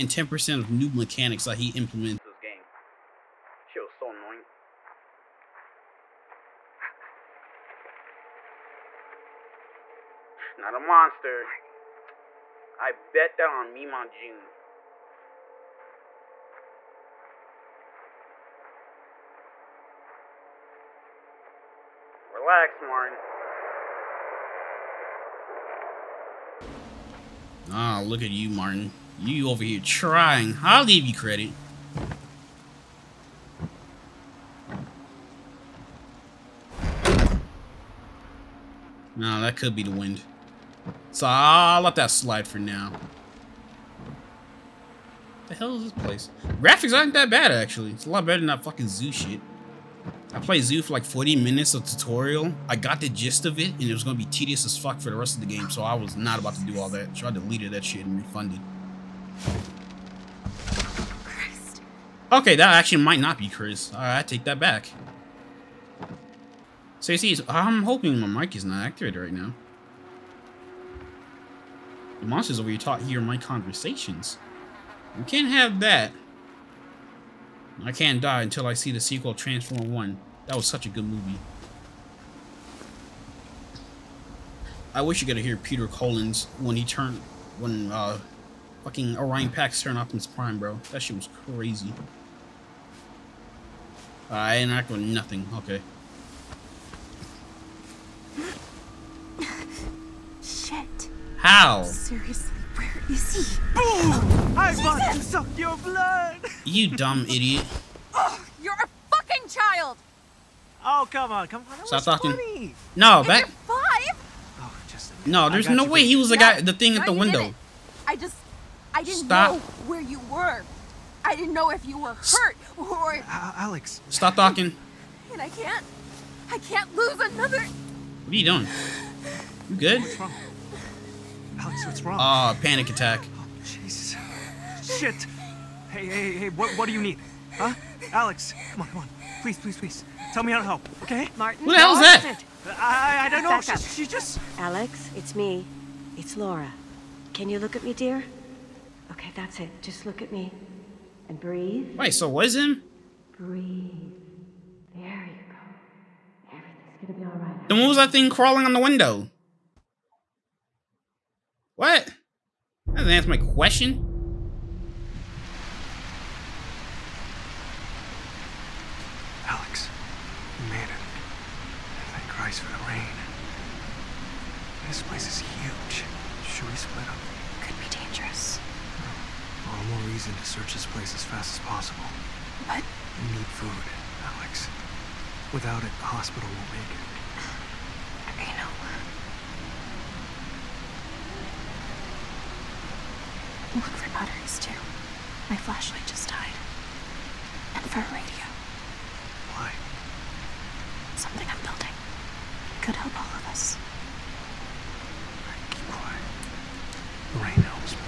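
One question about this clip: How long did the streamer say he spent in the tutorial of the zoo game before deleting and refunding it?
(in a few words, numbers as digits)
40 minutes.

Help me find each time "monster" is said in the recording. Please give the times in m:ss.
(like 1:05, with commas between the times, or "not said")
0:10, 1:12.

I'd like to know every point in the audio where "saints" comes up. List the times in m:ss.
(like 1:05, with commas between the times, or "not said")
not said.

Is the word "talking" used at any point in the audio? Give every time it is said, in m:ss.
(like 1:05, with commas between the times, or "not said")
1:52, 2:04.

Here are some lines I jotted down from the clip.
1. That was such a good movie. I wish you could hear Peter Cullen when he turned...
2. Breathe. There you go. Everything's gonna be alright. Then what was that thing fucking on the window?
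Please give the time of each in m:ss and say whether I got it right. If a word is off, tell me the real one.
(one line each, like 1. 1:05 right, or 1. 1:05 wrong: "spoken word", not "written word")
1. 1:20 right
2. 2:33 wrong: "crawling", not "fucking".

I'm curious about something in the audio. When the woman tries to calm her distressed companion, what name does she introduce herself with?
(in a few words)
Laura.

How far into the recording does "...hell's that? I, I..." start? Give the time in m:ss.
2:21.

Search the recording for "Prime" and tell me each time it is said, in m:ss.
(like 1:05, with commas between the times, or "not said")
1:30.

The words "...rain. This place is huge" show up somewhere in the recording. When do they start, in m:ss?
2:52.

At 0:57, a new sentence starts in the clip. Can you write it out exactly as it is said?
So I deleted that shit and refunded.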